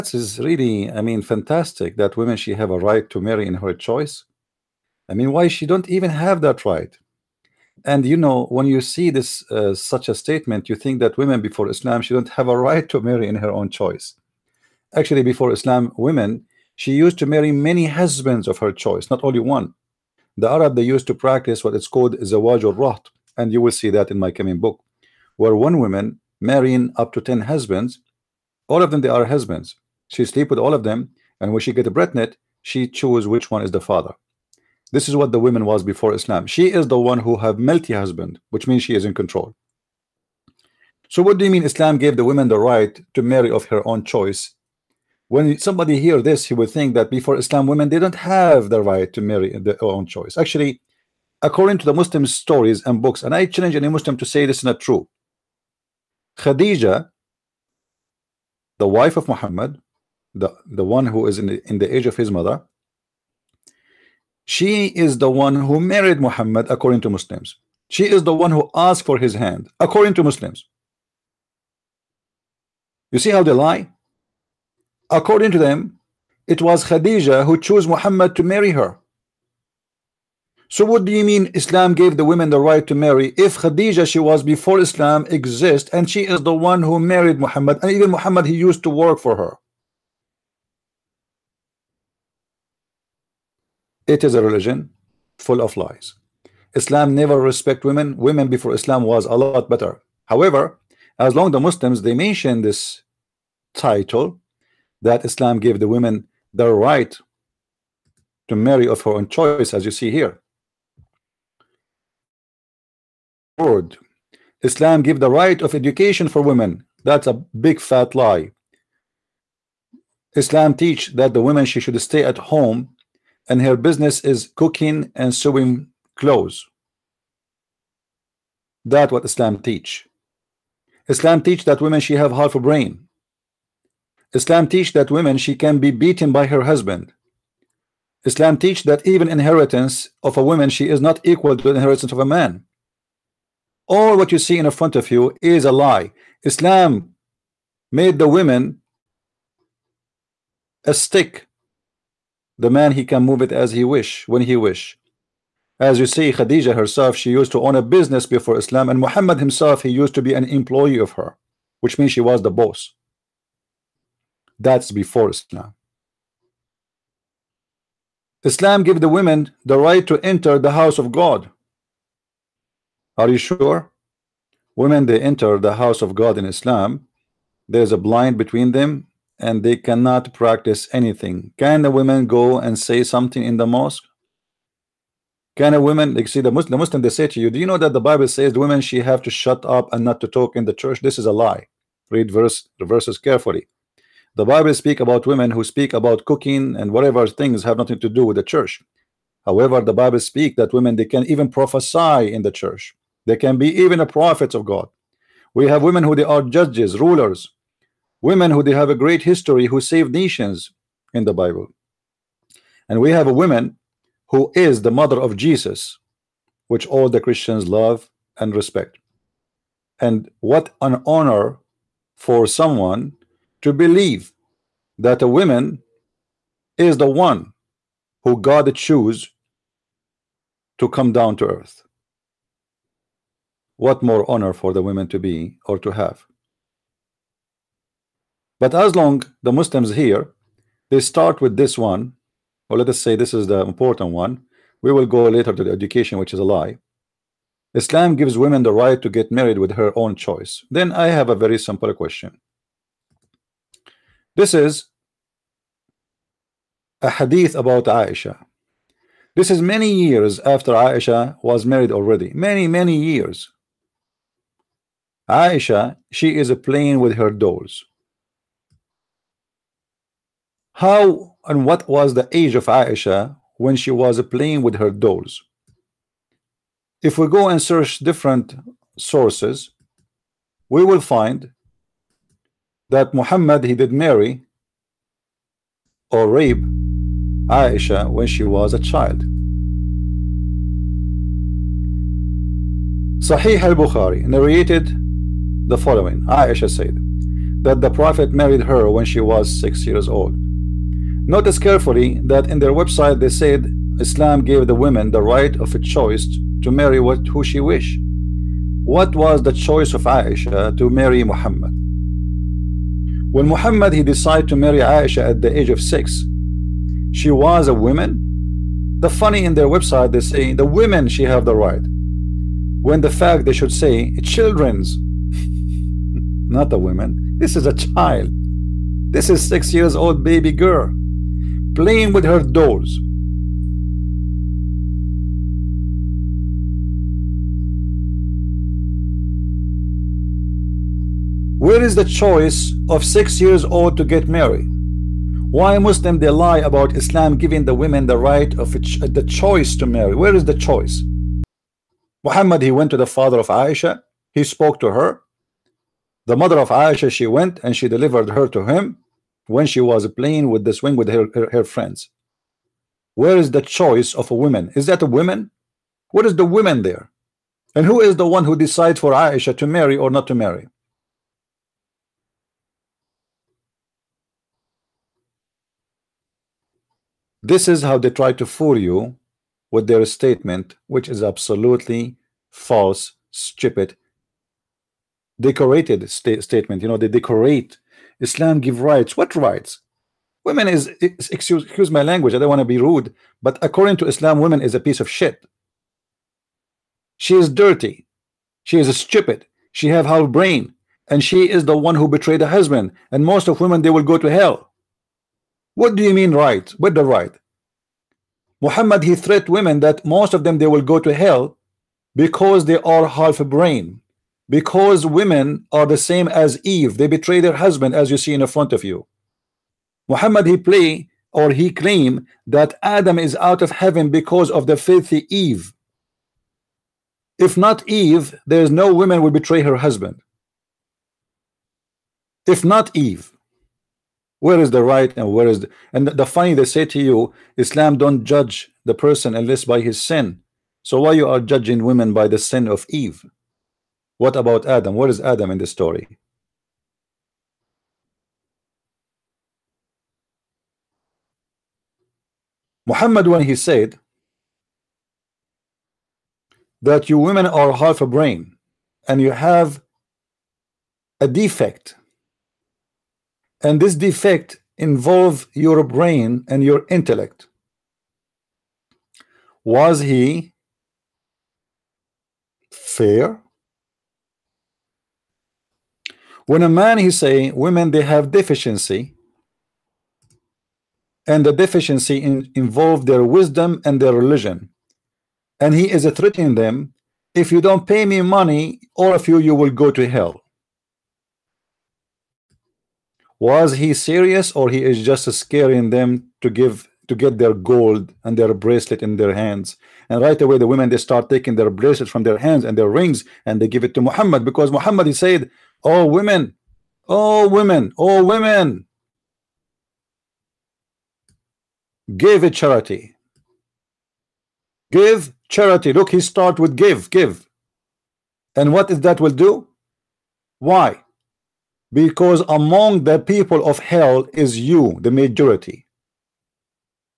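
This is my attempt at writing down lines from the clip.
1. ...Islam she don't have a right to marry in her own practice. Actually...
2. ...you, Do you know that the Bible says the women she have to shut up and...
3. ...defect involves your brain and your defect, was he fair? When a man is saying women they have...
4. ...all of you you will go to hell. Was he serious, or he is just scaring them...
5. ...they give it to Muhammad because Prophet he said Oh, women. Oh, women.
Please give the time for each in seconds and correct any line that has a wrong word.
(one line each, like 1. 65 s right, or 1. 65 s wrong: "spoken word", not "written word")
1. 11 s wrong: "choice", not "practice"
2. 187 s right
3. 463 s wrong: "intellect", not "defect"
4. 488 s right
5. 503 s wrong: "Muhammad", not "Prophet".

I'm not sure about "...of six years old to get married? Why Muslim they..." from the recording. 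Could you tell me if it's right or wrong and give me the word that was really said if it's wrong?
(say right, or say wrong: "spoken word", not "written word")
right.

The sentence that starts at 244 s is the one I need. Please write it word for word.
We will go later to the education, which is a lie.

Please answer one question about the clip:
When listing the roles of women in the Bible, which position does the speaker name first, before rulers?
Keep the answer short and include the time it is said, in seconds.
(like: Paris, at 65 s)
judges, at 206 s.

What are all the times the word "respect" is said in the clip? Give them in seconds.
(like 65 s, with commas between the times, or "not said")
97 s, 218 s.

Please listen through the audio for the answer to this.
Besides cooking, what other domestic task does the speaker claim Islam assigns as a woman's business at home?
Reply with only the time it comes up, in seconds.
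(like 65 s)
125 s.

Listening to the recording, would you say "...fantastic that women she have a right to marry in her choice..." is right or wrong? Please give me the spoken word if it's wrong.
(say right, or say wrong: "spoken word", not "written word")
right.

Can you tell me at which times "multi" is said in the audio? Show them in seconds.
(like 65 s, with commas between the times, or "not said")
37 s.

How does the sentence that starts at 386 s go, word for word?
You know, they decorate Islam give rights.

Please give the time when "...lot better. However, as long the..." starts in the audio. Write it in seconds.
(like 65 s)
99 s.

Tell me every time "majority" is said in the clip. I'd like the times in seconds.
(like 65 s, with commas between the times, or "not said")
525 s.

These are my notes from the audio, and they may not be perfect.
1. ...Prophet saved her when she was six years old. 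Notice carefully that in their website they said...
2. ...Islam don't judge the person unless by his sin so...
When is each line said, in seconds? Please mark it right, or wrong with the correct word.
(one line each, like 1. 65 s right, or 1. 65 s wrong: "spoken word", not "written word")
1. 297 s wrong: "married", not "saved"
2. 437 s right.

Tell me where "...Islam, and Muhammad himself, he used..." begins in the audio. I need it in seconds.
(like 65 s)
158 s.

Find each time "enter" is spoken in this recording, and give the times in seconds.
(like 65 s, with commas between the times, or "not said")
170 s, 175 s.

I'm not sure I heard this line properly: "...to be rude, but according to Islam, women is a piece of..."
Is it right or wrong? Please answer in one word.
right.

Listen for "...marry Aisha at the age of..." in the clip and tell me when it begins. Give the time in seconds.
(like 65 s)
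314 s.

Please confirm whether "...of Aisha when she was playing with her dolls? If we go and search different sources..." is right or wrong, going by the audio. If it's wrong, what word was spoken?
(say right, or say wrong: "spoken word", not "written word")
right.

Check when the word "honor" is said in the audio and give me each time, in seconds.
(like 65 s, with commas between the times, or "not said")
221 s, 234 s.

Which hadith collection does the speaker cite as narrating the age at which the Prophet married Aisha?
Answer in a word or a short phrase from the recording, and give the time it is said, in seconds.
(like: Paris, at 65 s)
Sahih al-Bukhari, at 293 s.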